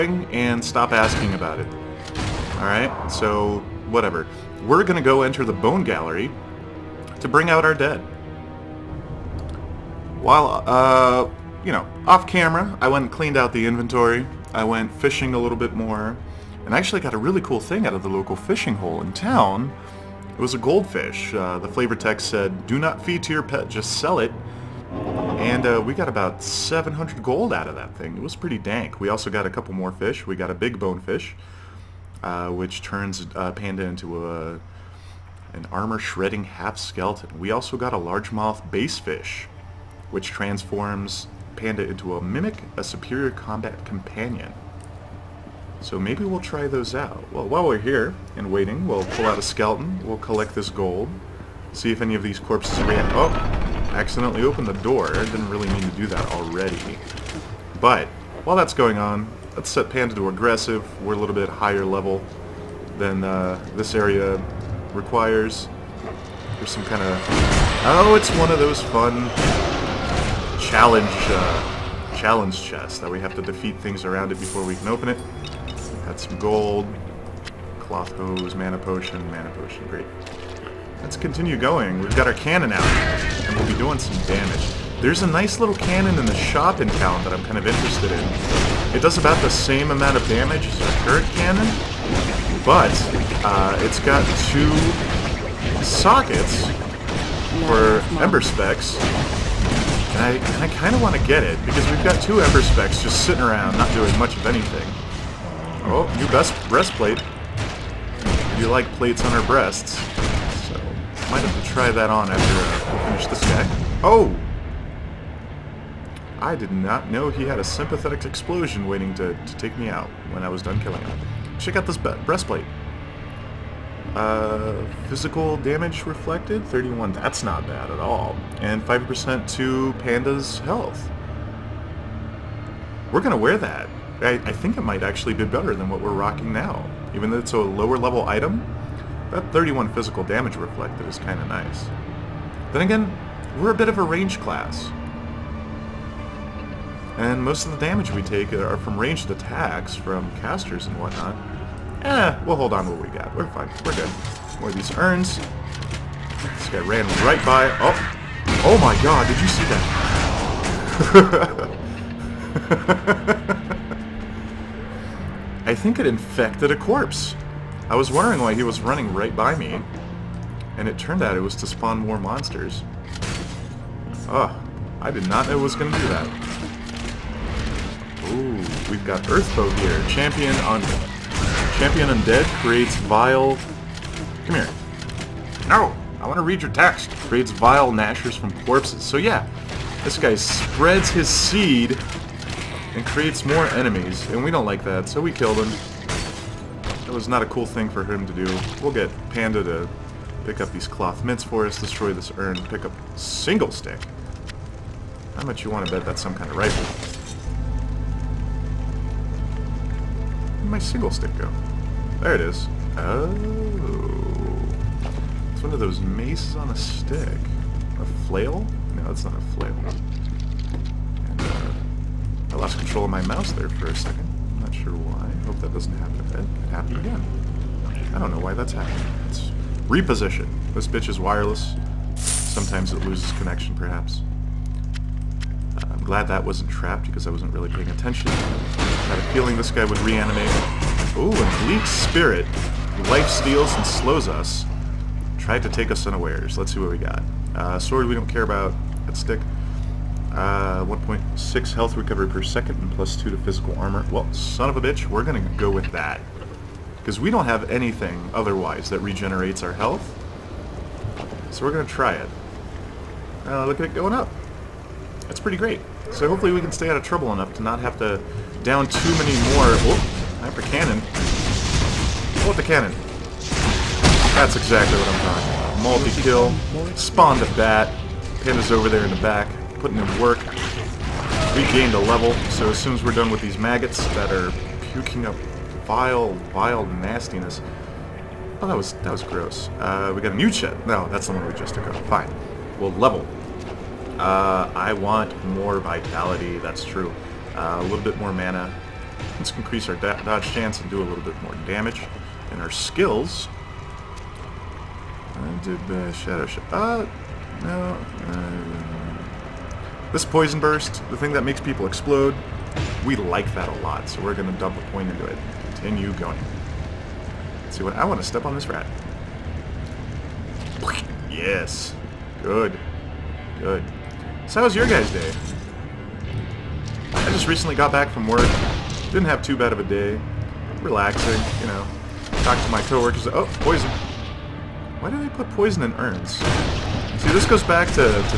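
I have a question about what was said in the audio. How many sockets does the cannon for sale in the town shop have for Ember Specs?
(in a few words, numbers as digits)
2.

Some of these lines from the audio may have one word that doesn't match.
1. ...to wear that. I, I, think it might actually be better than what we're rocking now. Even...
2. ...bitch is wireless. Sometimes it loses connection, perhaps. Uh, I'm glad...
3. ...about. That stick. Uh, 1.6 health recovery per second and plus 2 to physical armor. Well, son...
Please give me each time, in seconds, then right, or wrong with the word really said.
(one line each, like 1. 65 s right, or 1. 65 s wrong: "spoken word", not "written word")
1. 133 s right
2. 230 s right
3. 248 s right.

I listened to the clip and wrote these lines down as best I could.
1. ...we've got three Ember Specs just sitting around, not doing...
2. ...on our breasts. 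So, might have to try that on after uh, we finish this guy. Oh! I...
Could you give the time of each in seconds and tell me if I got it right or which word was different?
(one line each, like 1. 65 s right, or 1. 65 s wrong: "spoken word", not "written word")
1. 101 s wrong: "two", not "three"
2. 109 s right.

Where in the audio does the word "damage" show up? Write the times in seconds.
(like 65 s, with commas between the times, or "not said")
84 s, 90 s, 125 s, 140 s, 147 s, 301 s.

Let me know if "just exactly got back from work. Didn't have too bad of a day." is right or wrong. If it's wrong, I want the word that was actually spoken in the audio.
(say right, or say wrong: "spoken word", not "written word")
wrong: "recently", not "exactly".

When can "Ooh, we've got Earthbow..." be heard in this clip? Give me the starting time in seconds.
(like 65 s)
178 s.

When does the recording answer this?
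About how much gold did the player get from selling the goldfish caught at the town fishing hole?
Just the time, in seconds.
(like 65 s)
26 s.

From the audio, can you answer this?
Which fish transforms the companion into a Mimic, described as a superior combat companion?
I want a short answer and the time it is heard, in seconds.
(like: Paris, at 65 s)
largemouth bass, at 37 s.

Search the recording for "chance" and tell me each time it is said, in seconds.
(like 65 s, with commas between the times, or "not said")
300 s.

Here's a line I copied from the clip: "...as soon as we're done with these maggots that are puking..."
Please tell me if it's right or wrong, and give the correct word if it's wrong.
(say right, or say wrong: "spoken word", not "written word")
right.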